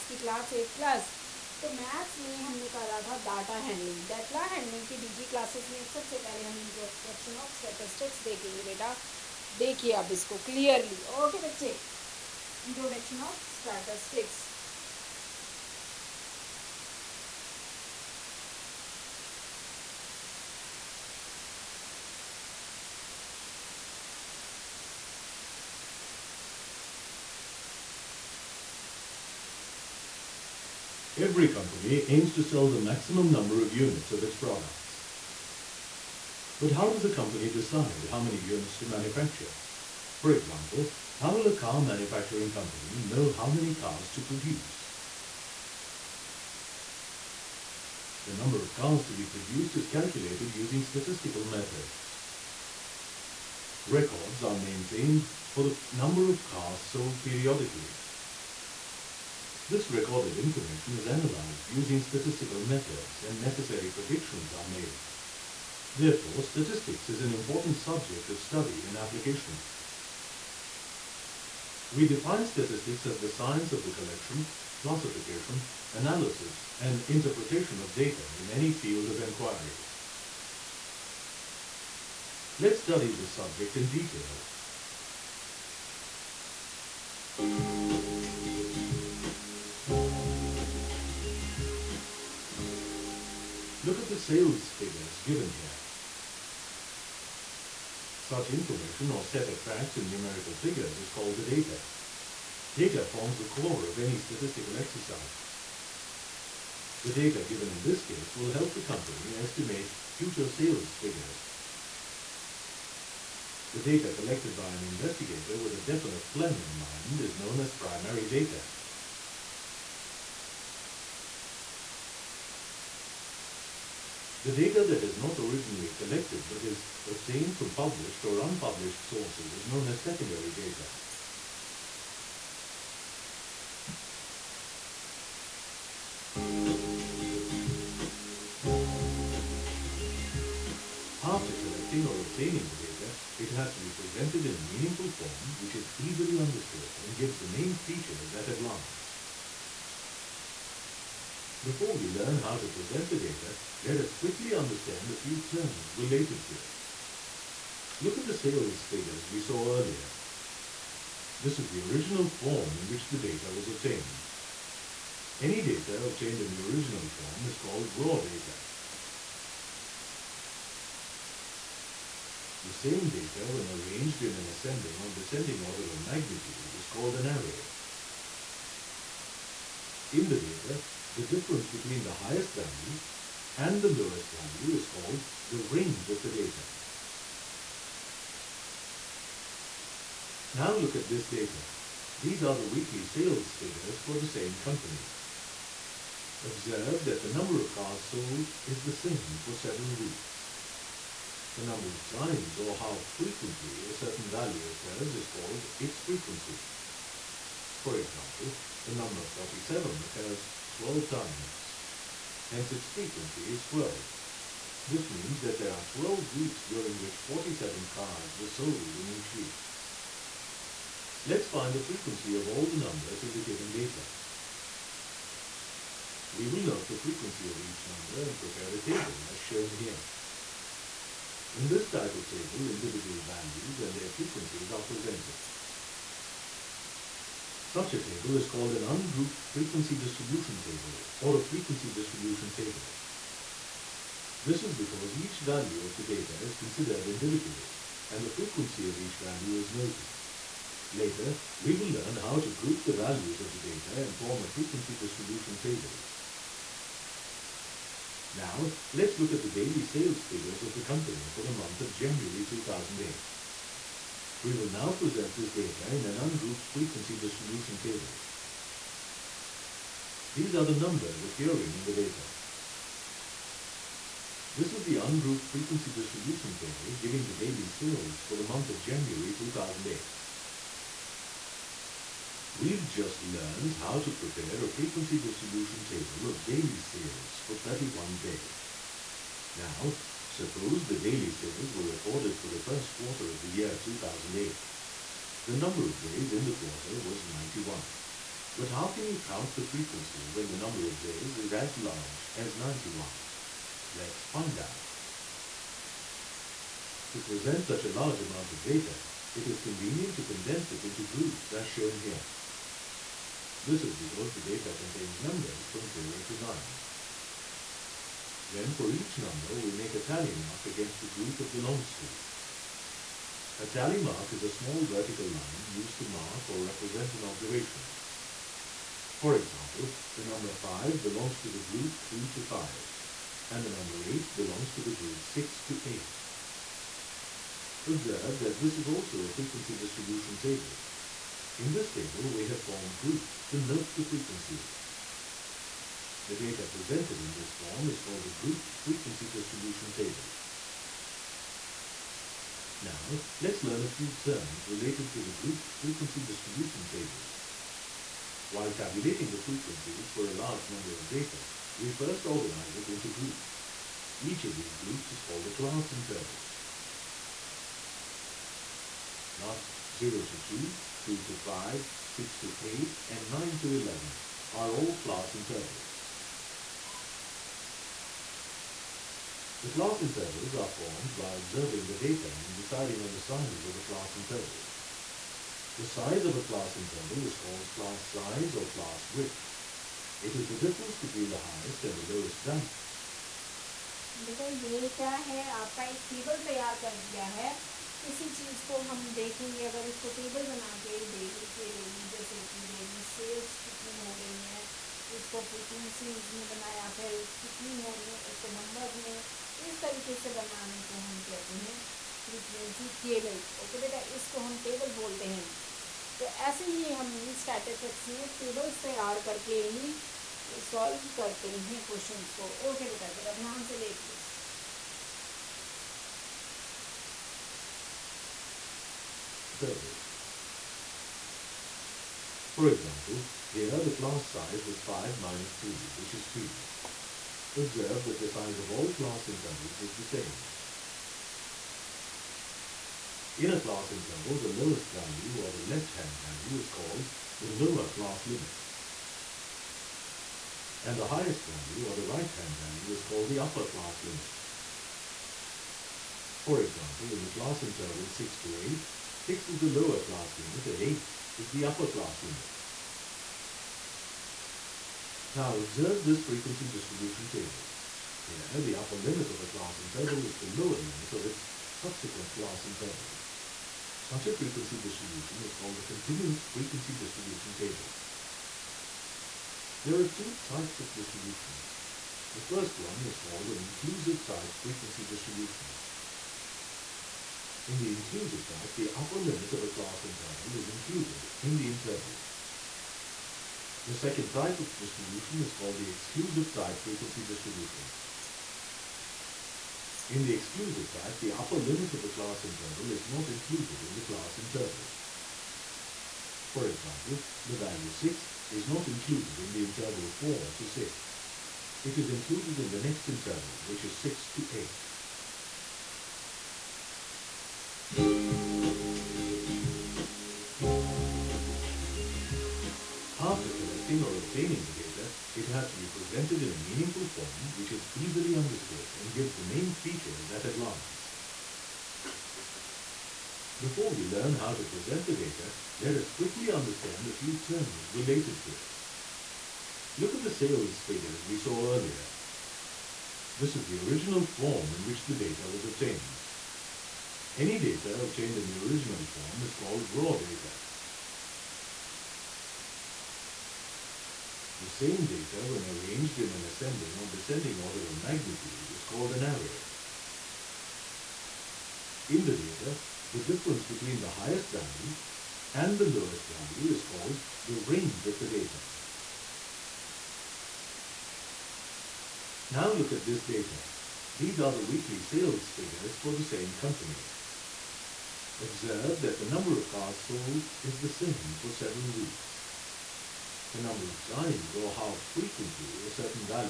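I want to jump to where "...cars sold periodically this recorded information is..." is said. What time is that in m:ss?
0:56.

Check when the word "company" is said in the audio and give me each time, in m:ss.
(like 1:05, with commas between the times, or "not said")
0:31, 0:37, 0:42, 1:48, 3:14, 4:20, 9:36.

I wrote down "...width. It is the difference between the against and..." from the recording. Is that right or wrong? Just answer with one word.
wrong.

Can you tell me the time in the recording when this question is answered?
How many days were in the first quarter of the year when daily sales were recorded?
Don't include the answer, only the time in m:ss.
4:55.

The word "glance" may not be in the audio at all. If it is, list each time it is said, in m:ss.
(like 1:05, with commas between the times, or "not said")
2:28, 8:50.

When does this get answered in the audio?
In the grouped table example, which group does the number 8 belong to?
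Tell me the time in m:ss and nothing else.
5:33.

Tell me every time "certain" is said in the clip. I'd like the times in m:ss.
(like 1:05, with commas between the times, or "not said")
3:23, 9:45.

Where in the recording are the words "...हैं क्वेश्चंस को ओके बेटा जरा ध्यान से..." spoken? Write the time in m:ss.
7:01.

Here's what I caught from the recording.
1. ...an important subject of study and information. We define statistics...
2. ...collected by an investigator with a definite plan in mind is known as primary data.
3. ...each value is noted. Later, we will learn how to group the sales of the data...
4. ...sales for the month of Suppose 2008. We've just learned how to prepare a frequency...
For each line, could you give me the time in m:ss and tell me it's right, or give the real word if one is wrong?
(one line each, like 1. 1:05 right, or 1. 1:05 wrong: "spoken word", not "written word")
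1. 1:07 wrong: "application", not "information"
2. 1:54 right
3. 4:08 wrong: "values", not "sales"
4. 4:37 wrong: "January", not "Suppose".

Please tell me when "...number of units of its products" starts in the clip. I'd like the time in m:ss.
0:33.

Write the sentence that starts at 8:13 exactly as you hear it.
The second type of distribution is called the exclusive type frequency distribution.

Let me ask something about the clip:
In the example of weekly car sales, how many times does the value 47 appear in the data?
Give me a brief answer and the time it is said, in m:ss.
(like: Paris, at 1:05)
12, at 3:28.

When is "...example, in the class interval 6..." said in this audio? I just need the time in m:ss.
7:36.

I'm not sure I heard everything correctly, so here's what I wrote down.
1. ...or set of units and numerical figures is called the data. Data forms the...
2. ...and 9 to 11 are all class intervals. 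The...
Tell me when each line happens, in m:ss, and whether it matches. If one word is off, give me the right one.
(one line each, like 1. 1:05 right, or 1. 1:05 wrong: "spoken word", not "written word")
1. 1:39 wrong: "facts", not "units"
2. 6:13 right.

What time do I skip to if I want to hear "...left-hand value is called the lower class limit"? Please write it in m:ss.
7:25.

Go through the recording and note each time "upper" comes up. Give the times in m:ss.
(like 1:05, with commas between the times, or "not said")
7:33, 7:41, 7:48, 8:08, 8:21.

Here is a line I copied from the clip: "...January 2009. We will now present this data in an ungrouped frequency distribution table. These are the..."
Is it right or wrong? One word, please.
wrong.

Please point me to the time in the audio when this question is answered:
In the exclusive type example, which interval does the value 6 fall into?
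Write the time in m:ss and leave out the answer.
8:33.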